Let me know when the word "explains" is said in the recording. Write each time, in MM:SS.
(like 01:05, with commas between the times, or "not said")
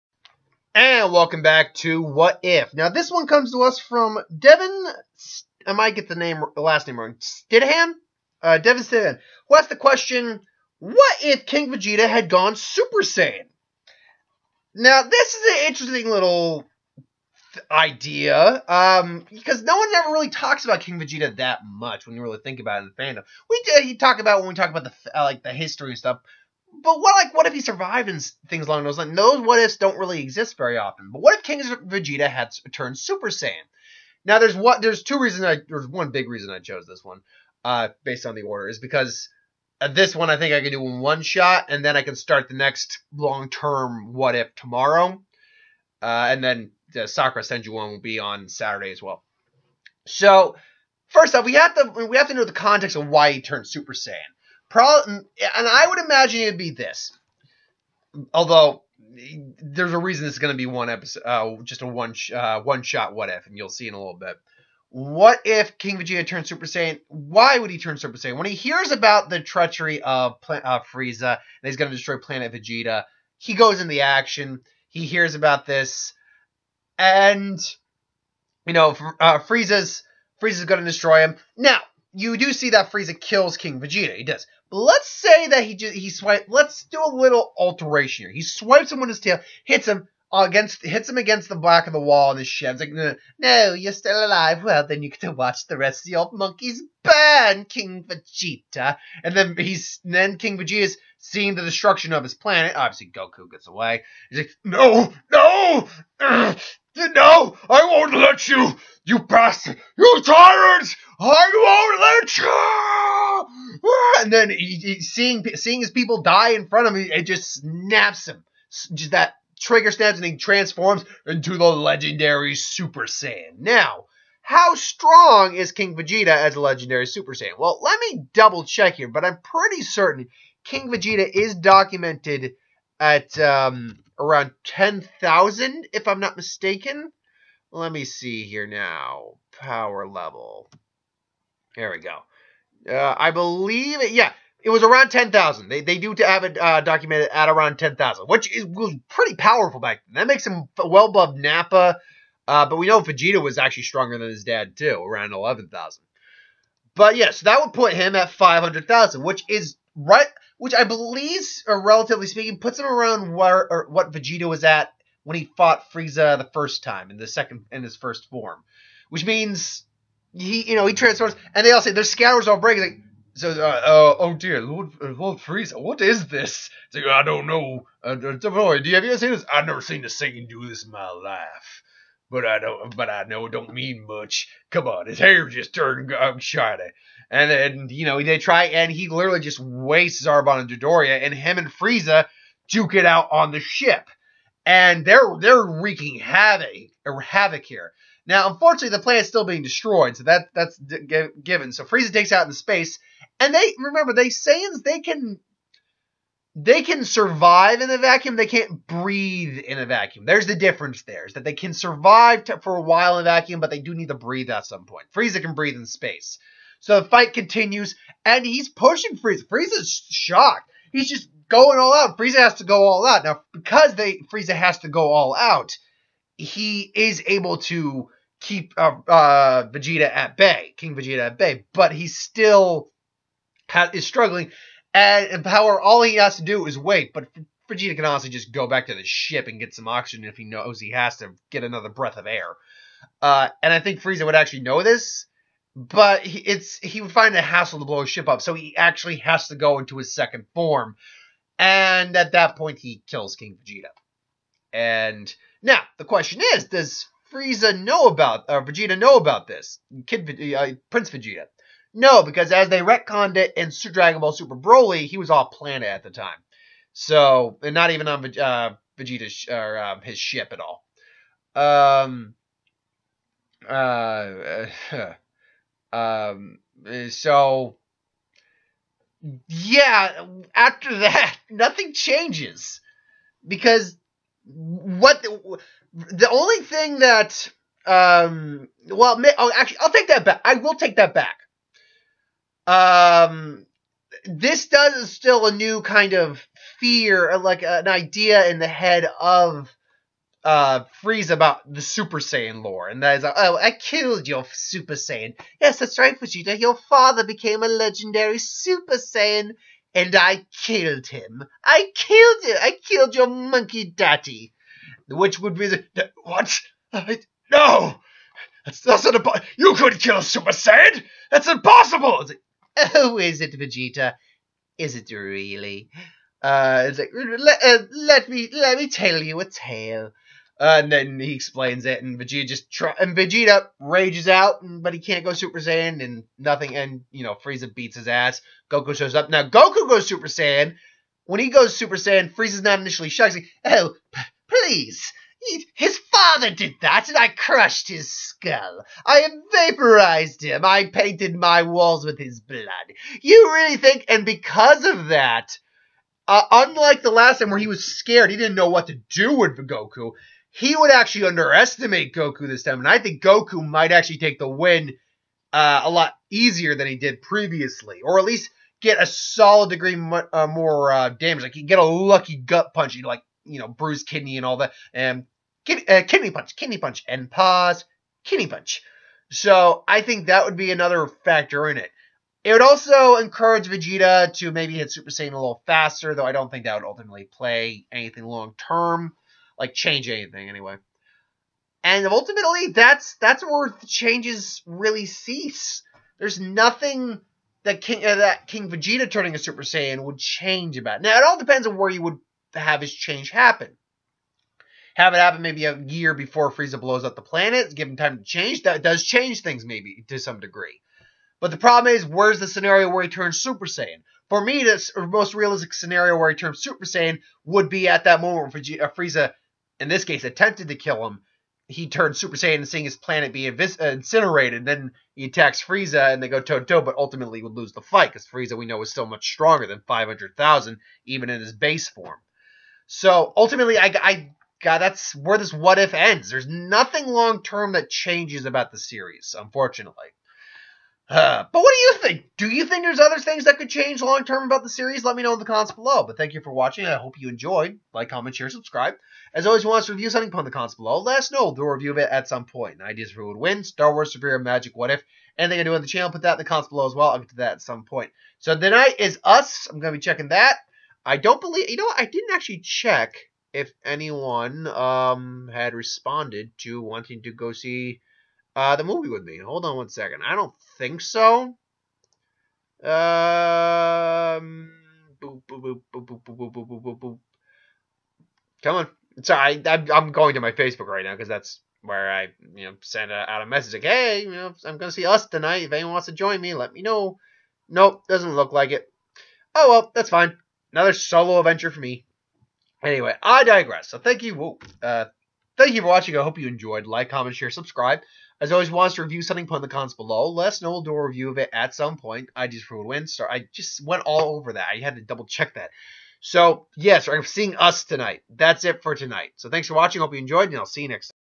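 05:31.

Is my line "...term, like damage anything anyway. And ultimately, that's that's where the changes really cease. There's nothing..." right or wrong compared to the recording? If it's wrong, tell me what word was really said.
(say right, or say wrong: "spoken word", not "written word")
wrong: "change", not "damage".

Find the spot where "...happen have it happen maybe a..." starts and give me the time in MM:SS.
06:43.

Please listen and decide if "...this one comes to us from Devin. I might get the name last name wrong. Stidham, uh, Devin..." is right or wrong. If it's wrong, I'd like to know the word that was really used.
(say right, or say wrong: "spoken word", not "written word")
right.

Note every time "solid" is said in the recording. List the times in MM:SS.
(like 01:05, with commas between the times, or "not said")
06:09.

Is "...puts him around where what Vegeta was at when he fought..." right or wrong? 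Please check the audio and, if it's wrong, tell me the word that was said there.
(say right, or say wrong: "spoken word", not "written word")
right.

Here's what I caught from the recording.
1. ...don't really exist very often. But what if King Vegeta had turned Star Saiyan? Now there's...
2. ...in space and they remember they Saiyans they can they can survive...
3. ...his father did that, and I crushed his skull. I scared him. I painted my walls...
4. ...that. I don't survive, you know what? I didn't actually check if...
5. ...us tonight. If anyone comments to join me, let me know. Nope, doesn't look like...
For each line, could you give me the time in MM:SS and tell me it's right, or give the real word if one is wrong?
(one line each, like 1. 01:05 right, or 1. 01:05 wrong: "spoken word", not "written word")
1. 00:29 wrong: "Super", not "Star"
2. 03:22 right
3. 05:45 wrong: "vaporized", not "scared"
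4. 07:40 wrong: "believe", not "survive"
5. 08:05 wrong: "wants", not "comments".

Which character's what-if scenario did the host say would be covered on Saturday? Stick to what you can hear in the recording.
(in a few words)
Sakura Senju.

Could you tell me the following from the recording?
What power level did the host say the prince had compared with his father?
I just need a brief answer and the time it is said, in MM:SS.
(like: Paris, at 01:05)
11,000, at 02:35.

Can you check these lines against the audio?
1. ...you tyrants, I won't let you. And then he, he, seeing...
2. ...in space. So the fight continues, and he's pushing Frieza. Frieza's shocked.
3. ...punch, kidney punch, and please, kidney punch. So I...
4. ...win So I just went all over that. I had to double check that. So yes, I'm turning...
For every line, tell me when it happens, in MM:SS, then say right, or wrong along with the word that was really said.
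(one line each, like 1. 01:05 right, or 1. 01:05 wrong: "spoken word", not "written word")
1. 01:49 right
2. 03:35 right
3. 06:16 wrong: "pause", not "please"
4. 08:22 wrong: "seeing", not "turning".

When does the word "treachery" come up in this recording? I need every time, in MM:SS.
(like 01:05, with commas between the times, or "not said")
01:09.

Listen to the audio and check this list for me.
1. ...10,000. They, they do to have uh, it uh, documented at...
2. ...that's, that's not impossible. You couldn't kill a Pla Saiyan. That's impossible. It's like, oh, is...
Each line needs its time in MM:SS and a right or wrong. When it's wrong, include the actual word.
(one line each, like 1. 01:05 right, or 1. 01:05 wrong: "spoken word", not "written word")
1. 02:25 right
2. 05:18 wrong: "Super", not "Pla".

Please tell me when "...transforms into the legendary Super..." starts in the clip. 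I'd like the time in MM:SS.
02:00.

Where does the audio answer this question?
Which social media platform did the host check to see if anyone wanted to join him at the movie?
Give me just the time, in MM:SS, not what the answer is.
08:00.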